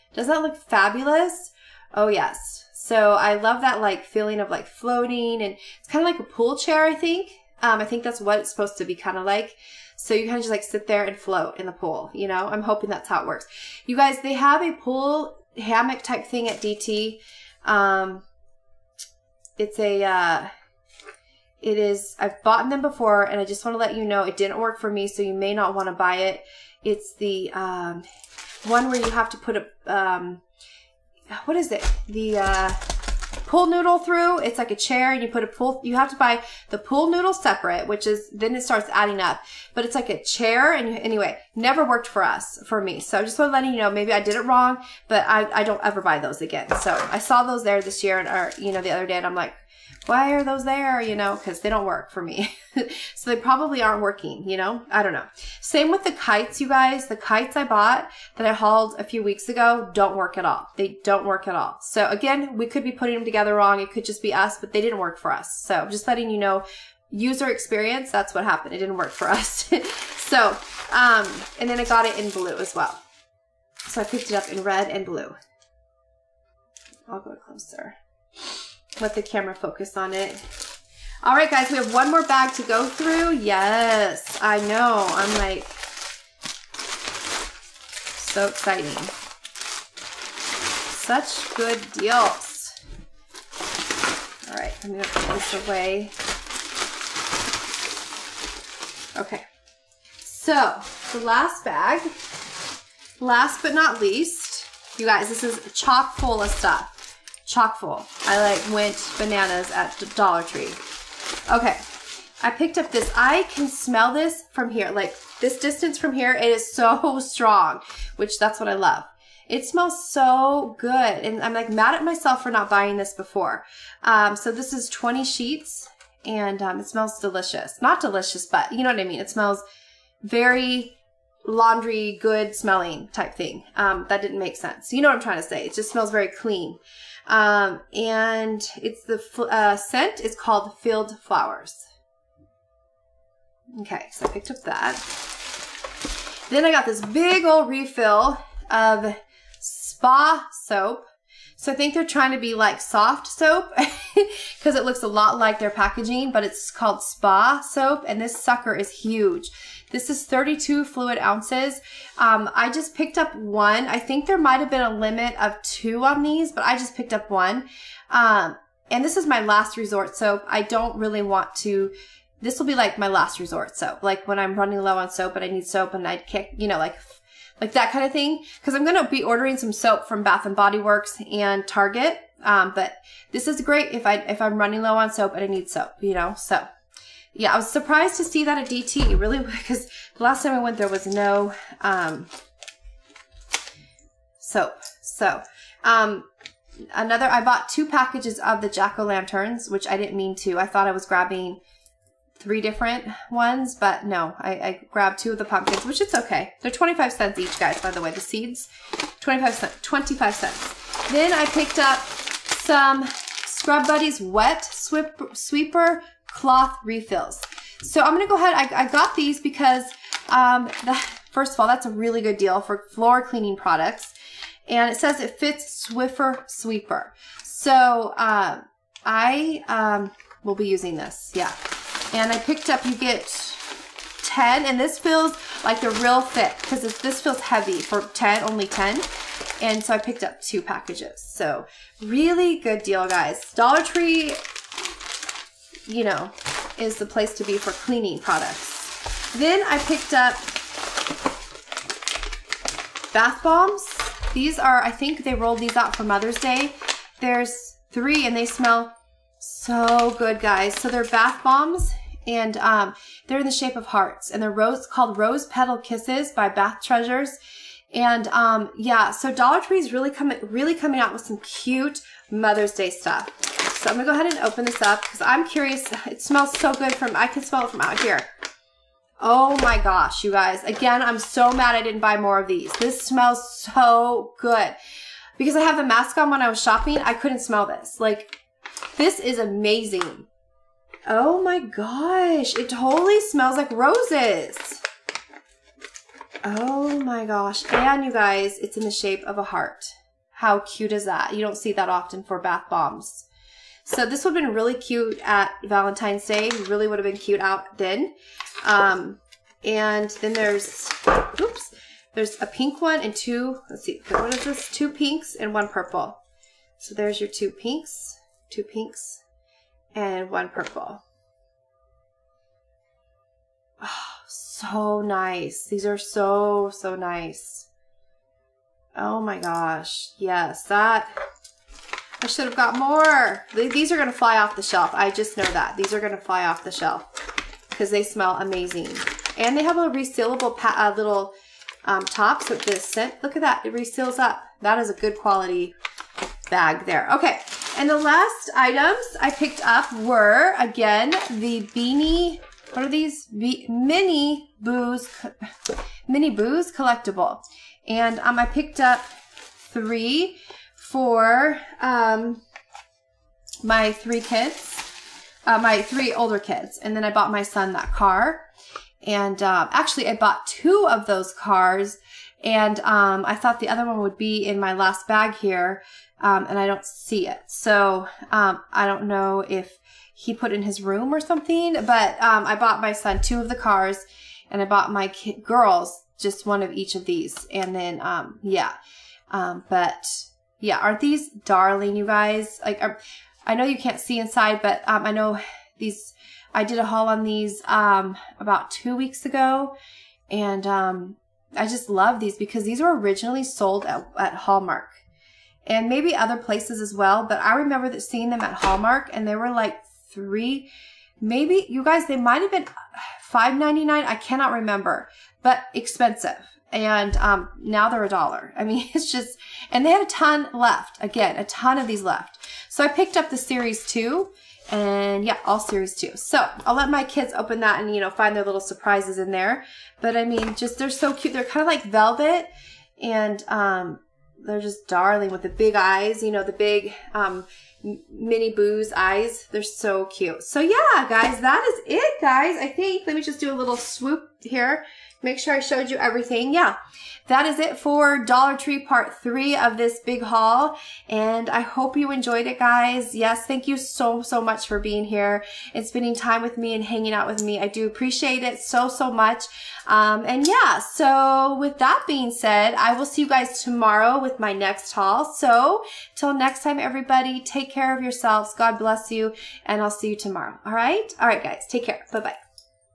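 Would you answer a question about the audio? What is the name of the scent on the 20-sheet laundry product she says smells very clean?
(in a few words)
Field Flowers.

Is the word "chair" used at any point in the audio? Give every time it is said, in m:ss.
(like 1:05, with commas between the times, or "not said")
0:06, 0:34, 0:40.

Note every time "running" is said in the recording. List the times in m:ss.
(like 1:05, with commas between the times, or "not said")
2:54, 3:04.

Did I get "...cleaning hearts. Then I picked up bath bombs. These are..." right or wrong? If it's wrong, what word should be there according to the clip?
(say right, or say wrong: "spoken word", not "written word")
wrong: "products", not "hearts".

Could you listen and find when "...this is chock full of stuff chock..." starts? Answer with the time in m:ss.
1:45.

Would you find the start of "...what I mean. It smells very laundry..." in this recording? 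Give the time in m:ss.
2:08.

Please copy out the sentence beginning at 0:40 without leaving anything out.
And you, anyway, never worked for us, for me.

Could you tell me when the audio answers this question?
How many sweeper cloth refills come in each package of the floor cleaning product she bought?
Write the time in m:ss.
3:52.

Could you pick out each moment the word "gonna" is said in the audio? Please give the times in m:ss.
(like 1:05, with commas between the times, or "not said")
3:38, 4:33.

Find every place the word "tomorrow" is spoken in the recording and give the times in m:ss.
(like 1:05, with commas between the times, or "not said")
7:43, 7:50.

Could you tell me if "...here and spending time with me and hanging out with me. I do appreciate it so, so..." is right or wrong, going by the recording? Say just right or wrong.
right.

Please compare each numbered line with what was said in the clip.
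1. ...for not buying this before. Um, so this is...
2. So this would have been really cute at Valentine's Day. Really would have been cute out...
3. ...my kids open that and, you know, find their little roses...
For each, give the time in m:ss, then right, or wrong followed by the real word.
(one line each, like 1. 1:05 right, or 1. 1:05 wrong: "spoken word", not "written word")
1. 2:02 right
2. 5:03 right
3. 7:06 wrong: "surprises", not "roses".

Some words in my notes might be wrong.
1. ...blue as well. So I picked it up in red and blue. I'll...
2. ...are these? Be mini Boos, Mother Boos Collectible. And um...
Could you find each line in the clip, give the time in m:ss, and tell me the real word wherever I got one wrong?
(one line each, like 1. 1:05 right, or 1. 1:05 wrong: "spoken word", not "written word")
1. 1:12 right
2. 5:52 wrong: "Mini", not "Mother".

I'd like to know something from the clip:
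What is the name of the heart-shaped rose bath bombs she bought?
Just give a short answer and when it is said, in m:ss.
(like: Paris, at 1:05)
Rose Petal Kisses, at 4:25.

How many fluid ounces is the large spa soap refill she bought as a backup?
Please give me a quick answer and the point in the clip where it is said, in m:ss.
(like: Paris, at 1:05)
32, at 2:40.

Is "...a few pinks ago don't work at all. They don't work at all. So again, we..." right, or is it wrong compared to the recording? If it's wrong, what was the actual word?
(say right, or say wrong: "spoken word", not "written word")
wrong: "weeks", not "pinks".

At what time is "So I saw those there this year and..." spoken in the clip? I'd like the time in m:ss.
0:46.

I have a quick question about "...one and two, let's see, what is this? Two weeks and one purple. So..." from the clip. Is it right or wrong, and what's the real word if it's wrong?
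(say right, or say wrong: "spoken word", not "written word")
wrong: "pinks", not "weeks".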